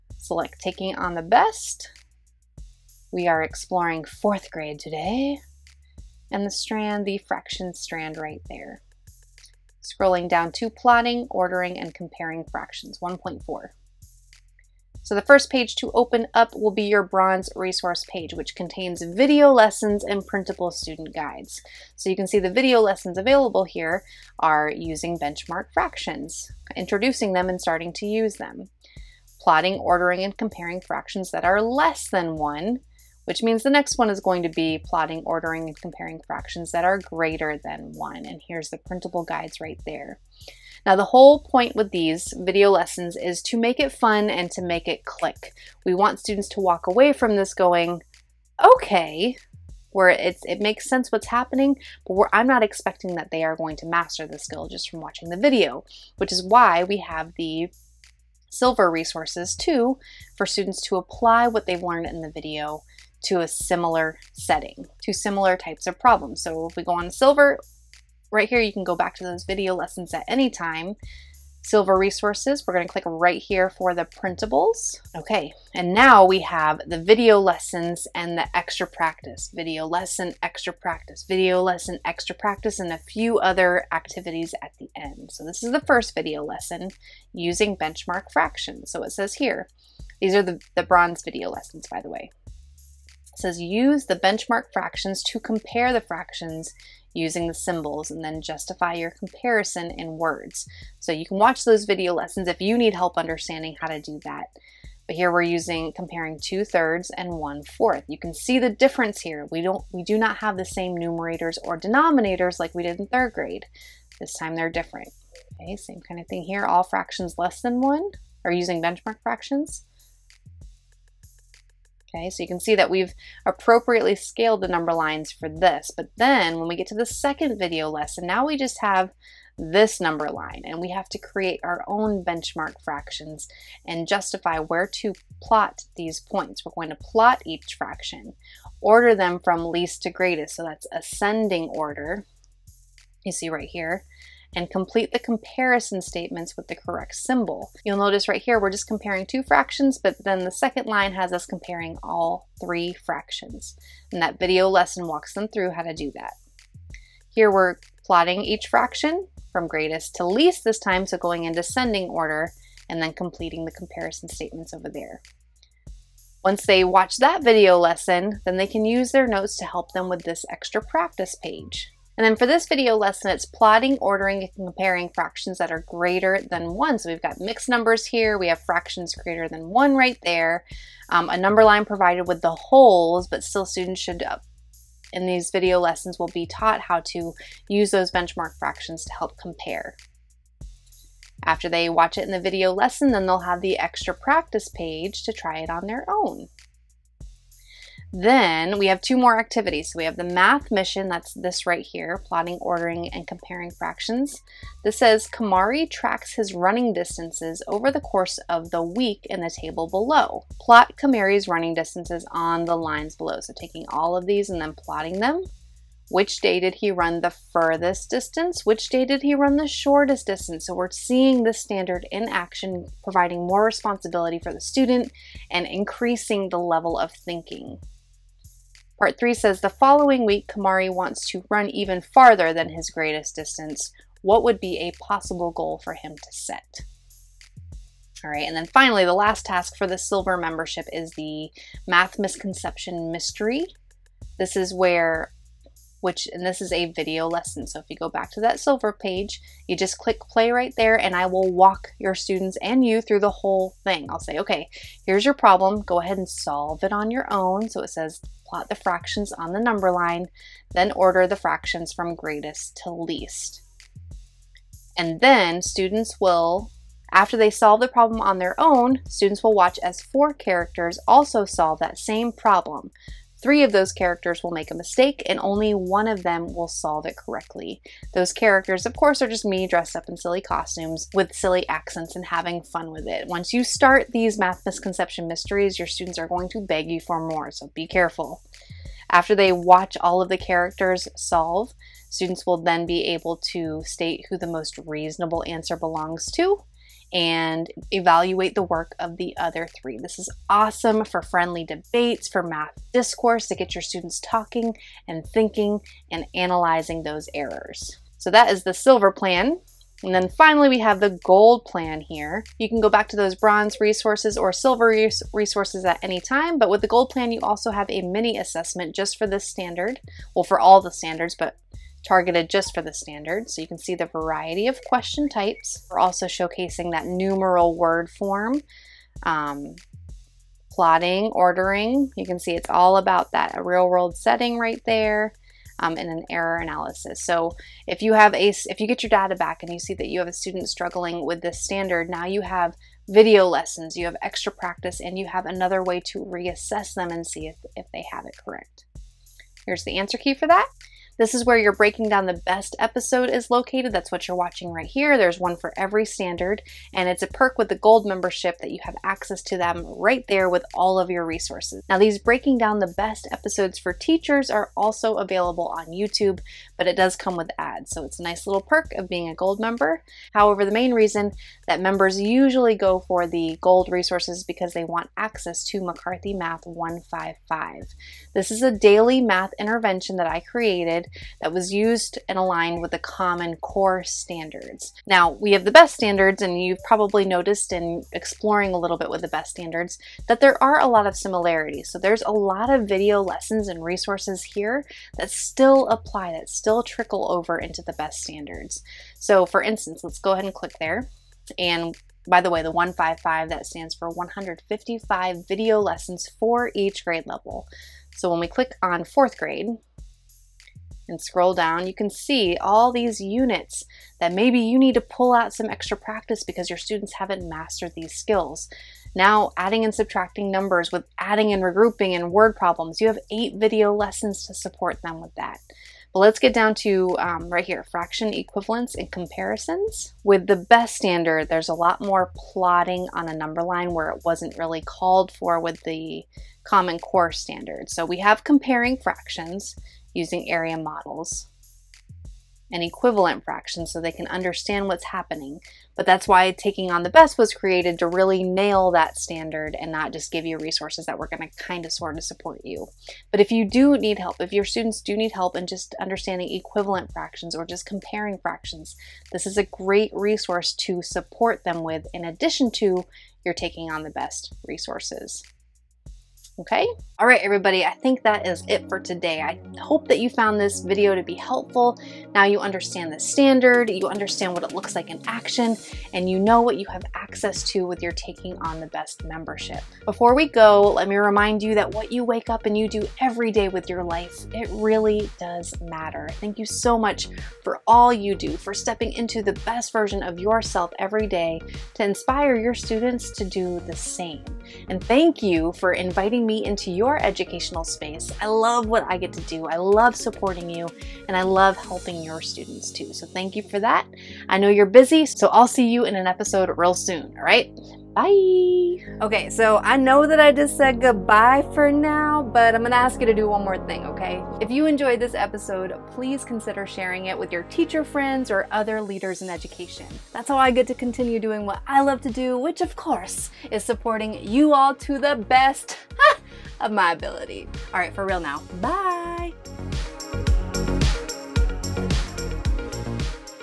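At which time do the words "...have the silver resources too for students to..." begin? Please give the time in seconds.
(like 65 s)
56 s.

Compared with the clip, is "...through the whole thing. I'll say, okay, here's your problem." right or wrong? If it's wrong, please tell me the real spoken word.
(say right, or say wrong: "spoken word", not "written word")
right.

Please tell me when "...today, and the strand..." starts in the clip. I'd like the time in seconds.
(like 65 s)
4 s.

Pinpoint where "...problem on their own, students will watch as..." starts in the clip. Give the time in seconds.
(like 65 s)
267 s.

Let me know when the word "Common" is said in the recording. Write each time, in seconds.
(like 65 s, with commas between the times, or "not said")
382 s, 436 s.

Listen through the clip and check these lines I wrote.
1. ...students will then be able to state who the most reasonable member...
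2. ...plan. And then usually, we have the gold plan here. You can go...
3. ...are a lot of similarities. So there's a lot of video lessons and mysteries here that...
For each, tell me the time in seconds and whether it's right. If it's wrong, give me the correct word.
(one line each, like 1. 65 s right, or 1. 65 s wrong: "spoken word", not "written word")
1. 292 s wrong: "answer", not "member"
2. 309 s wrong: "finally", not "usually"
3. 390 s wrong: "resources", not "mysteries".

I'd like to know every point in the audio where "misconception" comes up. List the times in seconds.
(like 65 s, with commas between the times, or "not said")
242 s, 284 s.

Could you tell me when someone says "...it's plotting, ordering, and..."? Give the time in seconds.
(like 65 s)
173 s.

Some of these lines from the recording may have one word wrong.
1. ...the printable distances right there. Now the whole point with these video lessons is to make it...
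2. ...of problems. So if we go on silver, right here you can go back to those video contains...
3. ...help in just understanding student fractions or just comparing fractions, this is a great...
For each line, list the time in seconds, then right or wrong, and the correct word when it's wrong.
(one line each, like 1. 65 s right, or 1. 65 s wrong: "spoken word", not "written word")
1. 38 s wrong: "guides", not "distances"
2. 65 s wrong: "lessons", not "contains"
3. 455 s wrong: "equivalent", not "student".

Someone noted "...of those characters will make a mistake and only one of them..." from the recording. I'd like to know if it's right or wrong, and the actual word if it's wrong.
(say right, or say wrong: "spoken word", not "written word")
right.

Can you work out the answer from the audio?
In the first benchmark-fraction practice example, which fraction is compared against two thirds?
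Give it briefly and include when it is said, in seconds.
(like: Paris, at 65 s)
one fourth, at 107 s.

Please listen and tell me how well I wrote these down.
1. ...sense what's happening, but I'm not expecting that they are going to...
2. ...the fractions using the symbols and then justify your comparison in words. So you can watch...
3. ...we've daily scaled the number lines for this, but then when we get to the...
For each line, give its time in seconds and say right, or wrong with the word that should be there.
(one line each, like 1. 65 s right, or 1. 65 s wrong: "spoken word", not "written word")
1. 50 s right
2. 95 s right
3. 122 s wrong: "appropriately", not "daily".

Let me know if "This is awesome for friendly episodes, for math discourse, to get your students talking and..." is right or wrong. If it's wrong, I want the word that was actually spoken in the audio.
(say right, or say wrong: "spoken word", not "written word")
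wrong: "debates", not "episodes".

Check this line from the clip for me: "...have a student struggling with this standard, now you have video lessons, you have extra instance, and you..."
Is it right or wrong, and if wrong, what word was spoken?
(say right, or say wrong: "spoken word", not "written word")
wrong: "practice", not "instance".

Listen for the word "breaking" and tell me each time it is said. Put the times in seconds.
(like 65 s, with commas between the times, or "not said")
351 s, 362 s.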